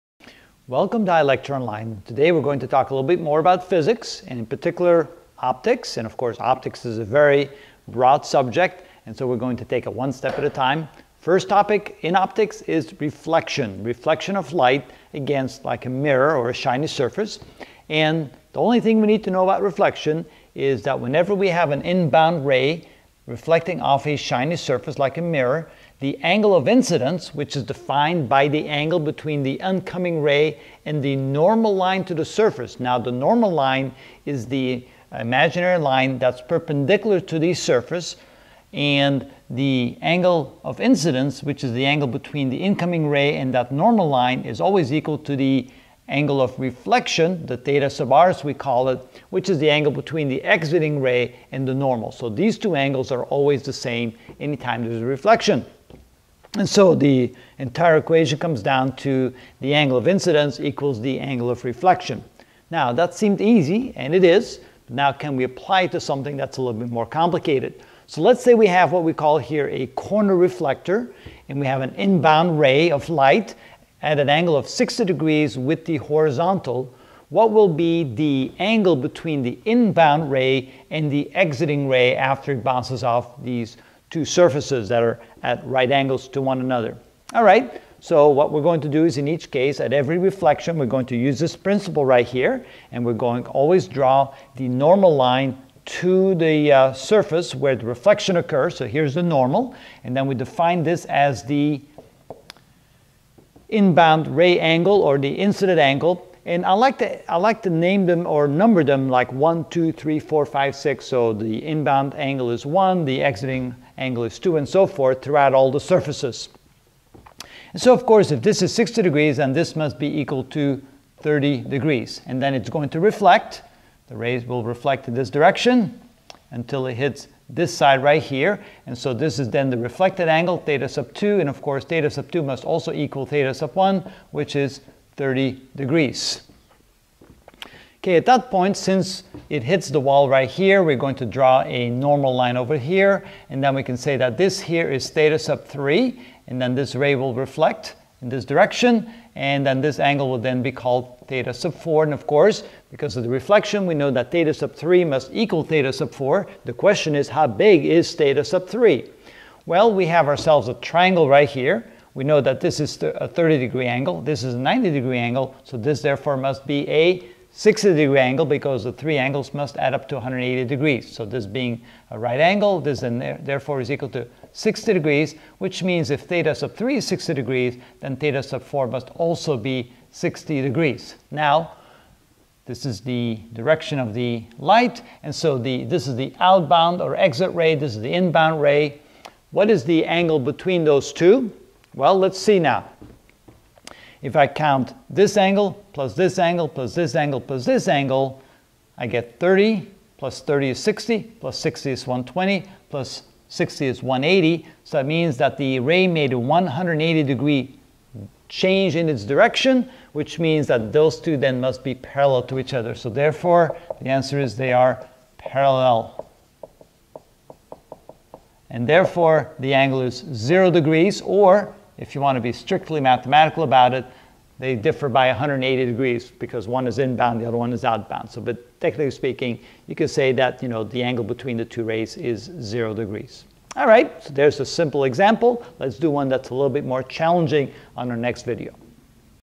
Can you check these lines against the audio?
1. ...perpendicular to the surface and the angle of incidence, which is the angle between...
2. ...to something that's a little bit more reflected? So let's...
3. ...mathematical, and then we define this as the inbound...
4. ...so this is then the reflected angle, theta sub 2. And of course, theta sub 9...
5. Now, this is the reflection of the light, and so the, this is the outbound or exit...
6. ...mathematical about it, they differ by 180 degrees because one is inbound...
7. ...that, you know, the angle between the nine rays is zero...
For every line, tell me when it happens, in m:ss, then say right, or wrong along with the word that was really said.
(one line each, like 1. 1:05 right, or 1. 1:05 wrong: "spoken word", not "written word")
1. 0:36 right
2. 1:05 wrong: "complicated", not "reflected"
3. 1:39 wrong: "normal", not "mathematical"
4. 2:08 wrong: "2", not "9"
5. 3:01 wrong: "direction", not "reflection"
6. 3:42 right
7. 3:50 wrong: "two", not "nine".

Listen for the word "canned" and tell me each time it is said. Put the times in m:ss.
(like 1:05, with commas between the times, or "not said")
not said.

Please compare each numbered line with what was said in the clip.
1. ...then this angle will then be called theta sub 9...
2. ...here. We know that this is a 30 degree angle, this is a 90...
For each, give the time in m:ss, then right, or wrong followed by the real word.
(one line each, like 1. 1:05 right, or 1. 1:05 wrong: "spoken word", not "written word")
1. 2:29 wrong: "4", not "9"
2. 2:41 right.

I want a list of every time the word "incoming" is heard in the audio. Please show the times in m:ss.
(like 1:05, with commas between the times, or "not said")
0:29, 0:42.